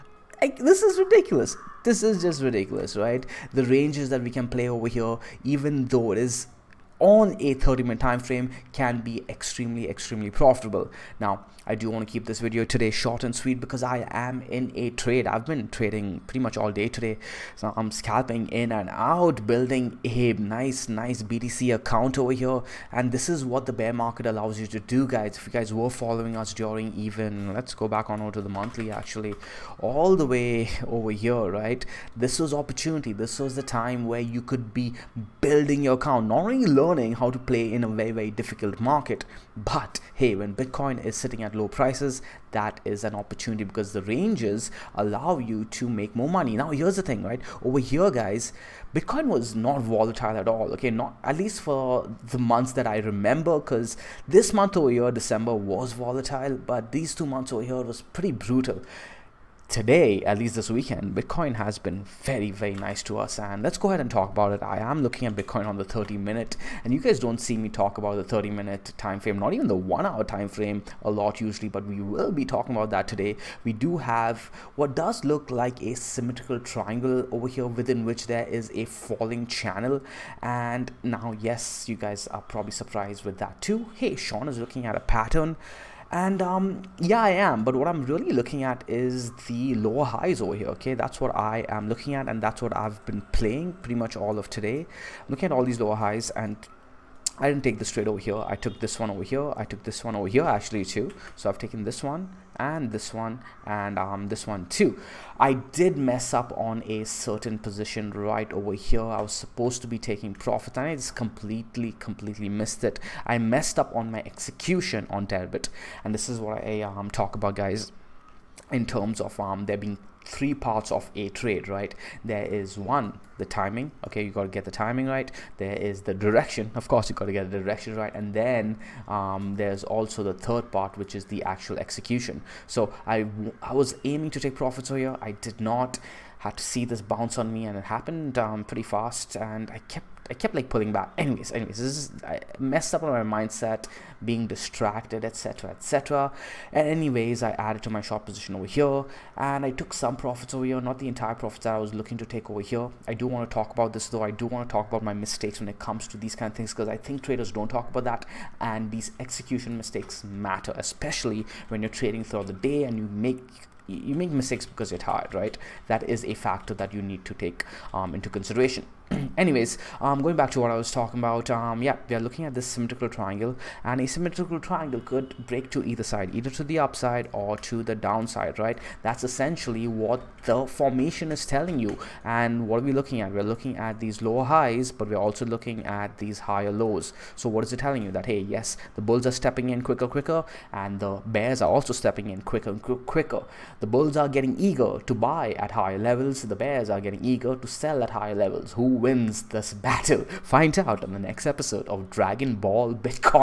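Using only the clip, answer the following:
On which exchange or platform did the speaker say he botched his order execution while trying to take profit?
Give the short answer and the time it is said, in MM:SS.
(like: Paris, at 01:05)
Deribit, at 01:55.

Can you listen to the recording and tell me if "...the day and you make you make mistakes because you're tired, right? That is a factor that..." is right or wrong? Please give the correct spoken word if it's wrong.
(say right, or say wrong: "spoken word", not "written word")
right.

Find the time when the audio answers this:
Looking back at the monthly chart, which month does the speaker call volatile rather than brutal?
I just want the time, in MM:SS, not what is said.
00:55.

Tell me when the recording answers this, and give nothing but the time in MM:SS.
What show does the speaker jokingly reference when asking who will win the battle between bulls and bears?
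03:22.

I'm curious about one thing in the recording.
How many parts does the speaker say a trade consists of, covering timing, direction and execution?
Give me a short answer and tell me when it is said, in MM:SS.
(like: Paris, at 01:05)
3, at 02:00.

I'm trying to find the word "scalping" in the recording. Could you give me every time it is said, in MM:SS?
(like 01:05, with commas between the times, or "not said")
00:17.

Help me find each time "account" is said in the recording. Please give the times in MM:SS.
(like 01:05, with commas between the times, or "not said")
00:21, 00:35.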